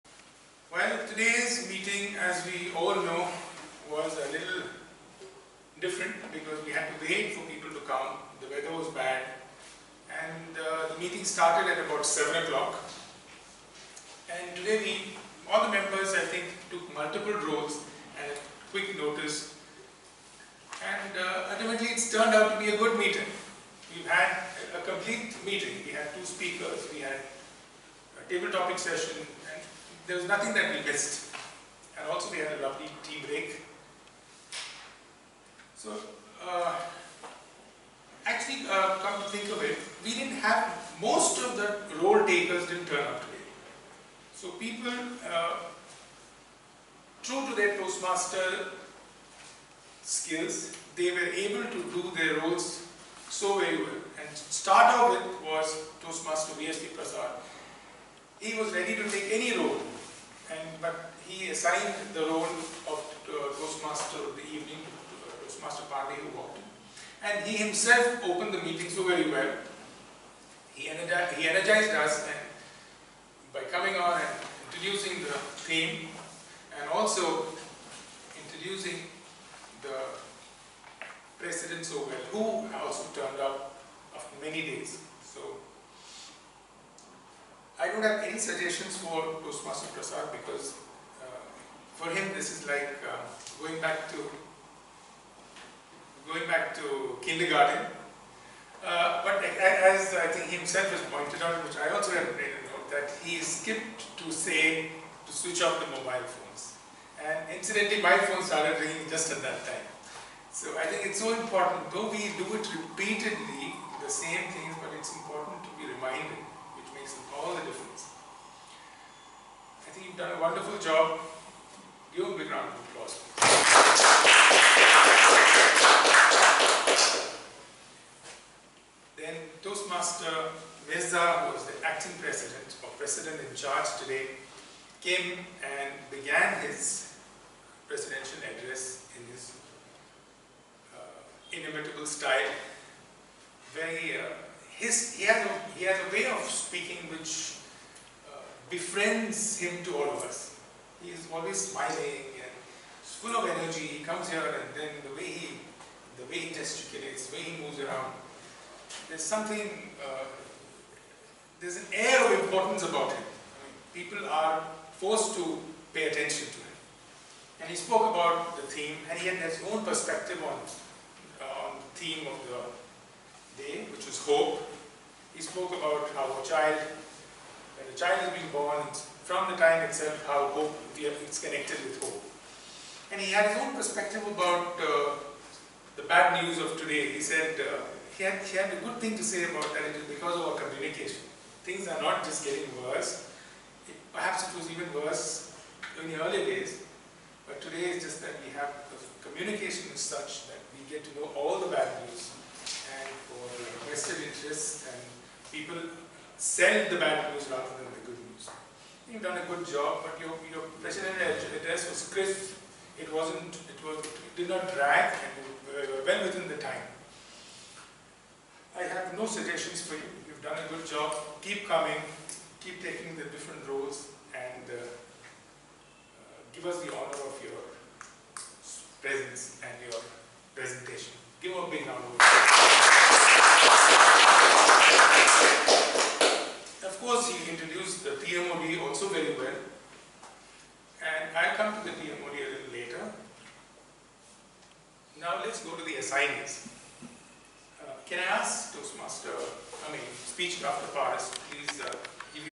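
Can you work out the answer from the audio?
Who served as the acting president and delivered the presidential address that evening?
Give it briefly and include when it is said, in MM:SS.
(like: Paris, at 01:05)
Mirza, at 02:10.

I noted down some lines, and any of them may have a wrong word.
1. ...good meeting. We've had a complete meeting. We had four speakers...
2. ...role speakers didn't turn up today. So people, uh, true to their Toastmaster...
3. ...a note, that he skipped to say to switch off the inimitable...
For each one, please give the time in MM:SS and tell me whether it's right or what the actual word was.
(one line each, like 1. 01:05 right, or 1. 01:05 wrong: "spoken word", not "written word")
1. 00:22 wrong: "two", not "four"
2. 00:42 wrong: "takers", not "speakers"
3. 01:42 wrong: "mobile", not "inimitable".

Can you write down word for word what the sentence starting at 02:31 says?
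He is always smiling and full of energy.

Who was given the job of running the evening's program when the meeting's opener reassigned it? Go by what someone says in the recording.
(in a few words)
Pandey.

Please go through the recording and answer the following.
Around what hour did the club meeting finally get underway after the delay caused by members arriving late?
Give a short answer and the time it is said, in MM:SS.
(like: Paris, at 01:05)
7 o'clock, at 00:12.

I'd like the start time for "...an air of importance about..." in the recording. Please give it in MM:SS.
02:41.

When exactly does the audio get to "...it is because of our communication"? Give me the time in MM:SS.
03:09.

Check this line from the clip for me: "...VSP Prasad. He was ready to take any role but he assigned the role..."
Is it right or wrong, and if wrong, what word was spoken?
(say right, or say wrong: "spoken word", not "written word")
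right.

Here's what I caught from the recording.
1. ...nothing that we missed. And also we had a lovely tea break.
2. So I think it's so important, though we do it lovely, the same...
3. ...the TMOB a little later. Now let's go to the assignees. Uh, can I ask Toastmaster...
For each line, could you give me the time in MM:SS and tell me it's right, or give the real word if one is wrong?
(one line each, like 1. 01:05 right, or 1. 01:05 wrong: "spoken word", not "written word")
1. 00:30 right
2. 01:50 wrong: "repeatedly", not "lovely"
3. 04:01 right.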